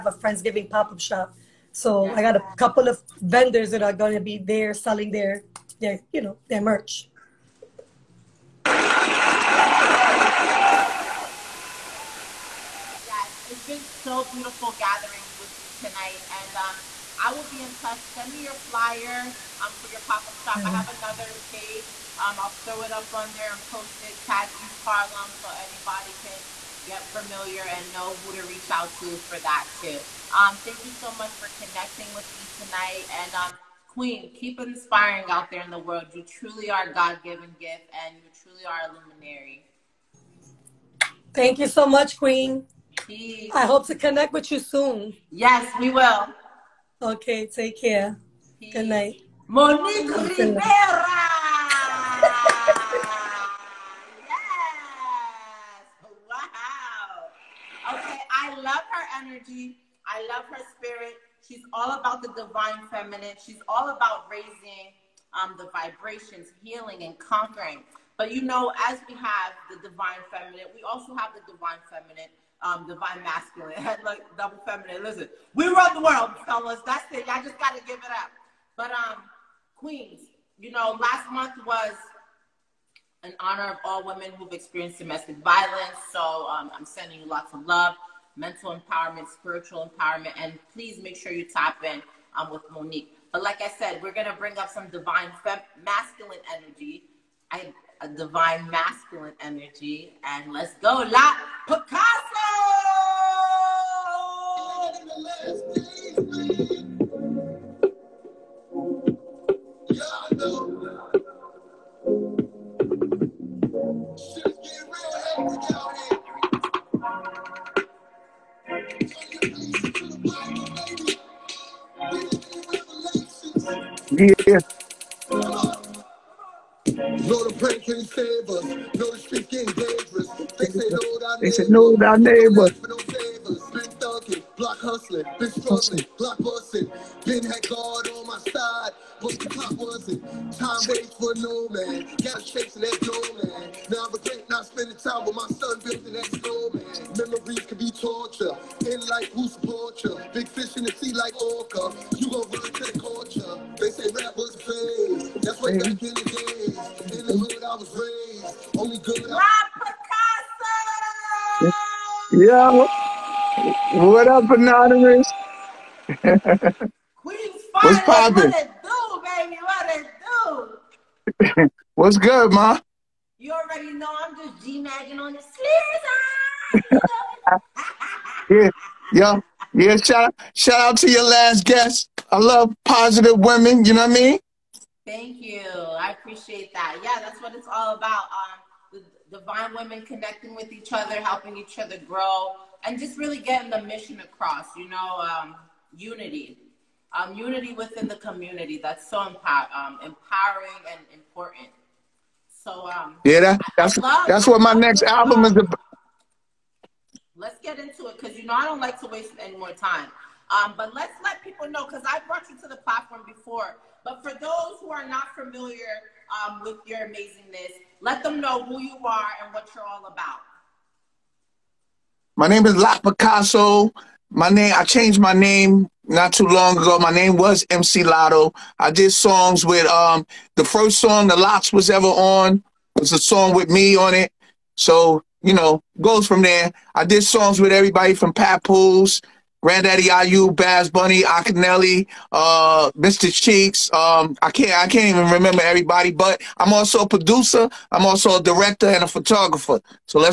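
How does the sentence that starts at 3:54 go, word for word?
So, you know, goes from there.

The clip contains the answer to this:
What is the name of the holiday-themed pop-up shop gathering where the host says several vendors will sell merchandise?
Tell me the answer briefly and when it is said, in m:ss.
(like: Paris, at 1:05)
Friendsgiving, at 0:00.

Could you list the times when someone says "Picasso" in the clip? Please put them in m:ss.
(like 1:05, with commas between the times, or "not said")
1:41, 3:42.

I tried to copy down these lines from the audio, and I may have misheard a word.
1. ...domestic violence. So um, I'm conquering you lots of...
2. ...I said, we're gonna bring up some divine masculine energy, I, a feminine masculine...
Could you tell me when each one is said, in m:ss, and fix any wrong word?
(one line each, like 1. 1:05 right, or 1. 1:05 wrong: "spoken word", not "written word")
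1. 1:24 wrong: "sending", not "conquering"
2. 1:33 wrong: "divine", not "feminine".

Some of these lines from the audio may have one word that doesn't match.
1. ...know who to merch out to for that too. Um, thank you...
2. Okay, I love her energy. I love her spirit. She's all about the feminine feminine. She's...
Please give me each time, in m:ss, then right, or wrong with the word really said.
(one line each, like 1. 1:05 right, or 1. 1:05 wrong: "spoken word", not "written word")
1. 0:27 wrong: "reach", not "merch"
2. 0:57 wrong: "divine", not "feminine".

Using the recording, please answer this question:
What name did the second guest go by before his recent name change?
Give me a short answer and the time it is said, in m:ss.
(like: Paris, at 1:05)
MC Lotto, at 3:47.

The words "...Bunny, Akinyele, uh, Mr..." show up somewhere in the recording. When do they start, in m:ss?
4:00.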